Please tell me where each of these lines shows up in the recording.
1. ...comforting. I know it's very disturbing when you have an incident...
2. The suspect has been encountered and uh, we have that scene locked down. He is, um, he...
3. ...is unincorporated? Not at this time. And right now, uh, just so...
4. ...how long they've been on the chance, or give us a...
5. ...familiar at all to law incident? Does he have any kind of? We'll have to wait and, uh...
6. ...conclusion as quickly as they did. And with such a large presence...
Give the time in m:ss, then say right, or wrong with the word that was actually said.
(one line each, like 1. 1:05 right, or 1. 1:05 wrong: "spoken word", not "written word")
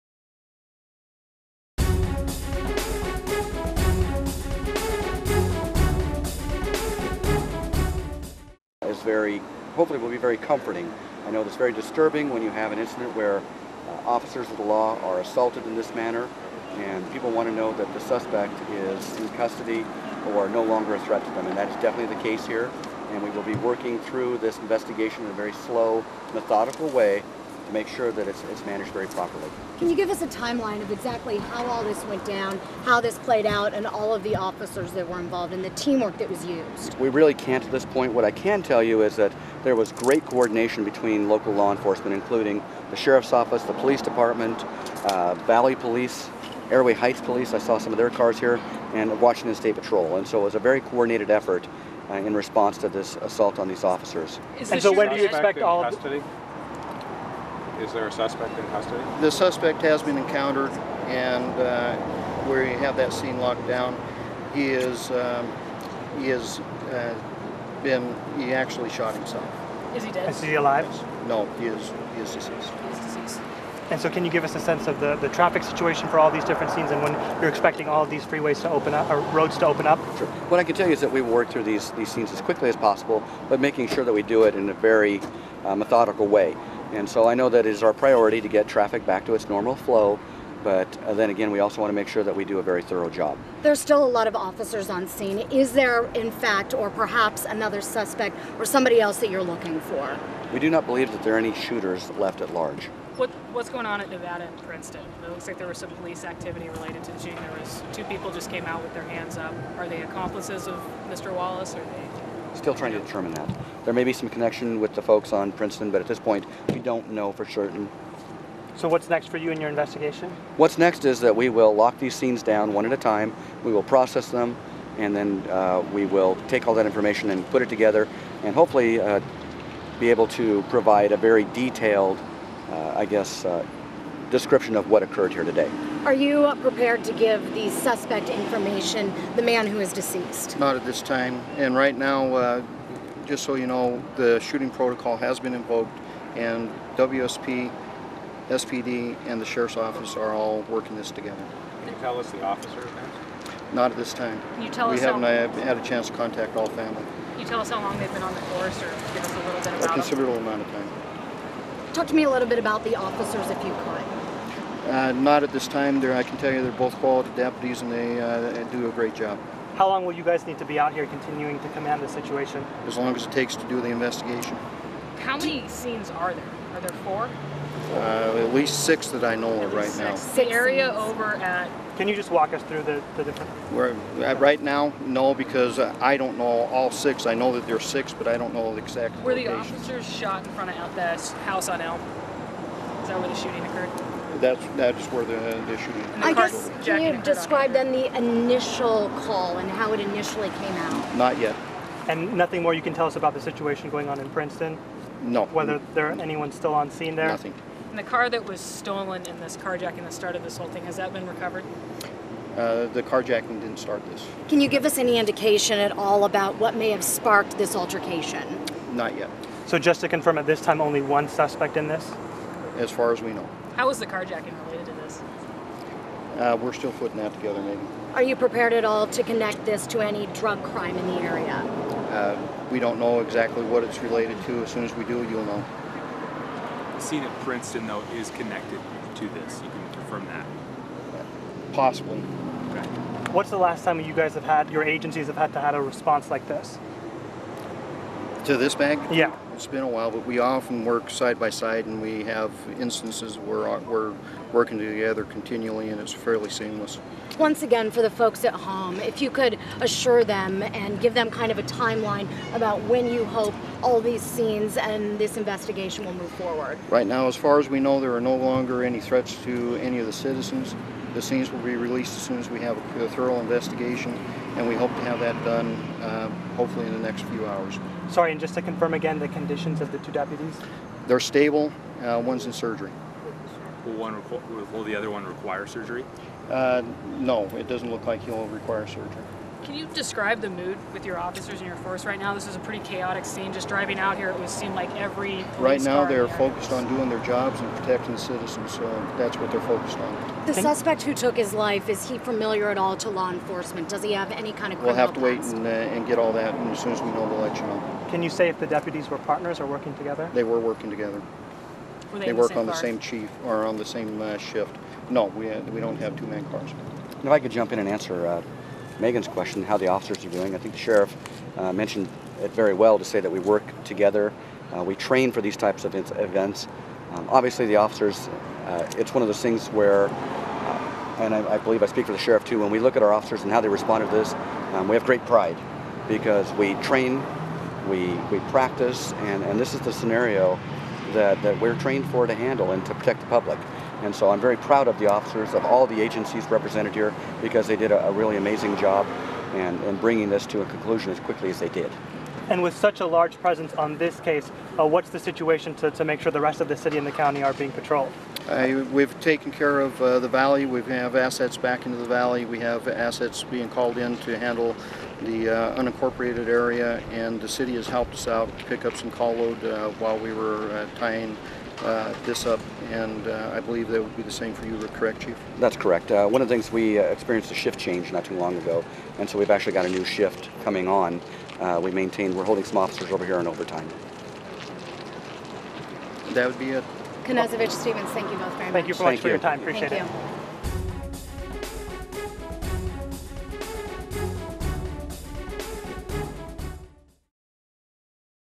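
1. 0:10 right
2. 0:59 right
3. 2:19 wrong: "deceased", not "unincorporated"
4. 2:37 wrong: "force", not "chance"
5. 5:02 wrong: "enforcement", not "incident"
6. 5:50 right.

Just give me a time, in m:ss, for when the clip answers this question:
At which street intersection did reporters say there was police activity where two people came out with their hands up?
1:44.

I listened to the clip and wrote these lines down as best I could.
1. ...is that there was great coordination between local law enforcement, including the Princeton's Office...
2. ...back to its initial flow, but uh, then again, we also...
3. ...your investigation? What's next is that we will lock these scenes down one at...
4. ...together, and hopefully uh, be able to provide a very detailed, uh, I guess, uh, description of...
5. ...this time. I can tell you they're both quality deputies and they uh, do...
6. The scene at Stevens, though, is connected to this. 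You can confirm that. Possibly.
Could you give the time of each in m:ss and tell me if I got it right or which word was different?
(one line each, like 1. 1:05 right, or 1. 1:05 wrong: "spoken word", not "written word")
1. 0:39 wrong: "Sheriff", not "Princeton"
2. 1:29 wrong: "normal", not "initial"
3. 1:59 right
4. 2:07 right
5. 2:45 right
6. 3:56 wrong: "Princeton", not "Stevens".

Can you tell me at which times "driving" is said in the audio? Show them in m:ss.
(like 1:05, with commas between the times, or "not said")
4:53.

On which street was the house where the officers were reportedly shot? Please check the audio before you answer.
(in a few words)
Elm.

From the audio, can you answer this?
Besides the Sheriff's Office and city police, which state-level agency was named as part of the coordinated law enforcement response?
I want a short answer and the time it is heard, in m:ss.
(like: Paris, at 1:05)
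Washington State Patrol, at 0:49.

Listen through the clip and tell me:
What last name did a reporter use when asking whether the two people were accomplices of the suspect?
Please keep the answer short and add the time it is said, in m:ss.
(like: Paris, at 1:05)
Wallace, at 1:51.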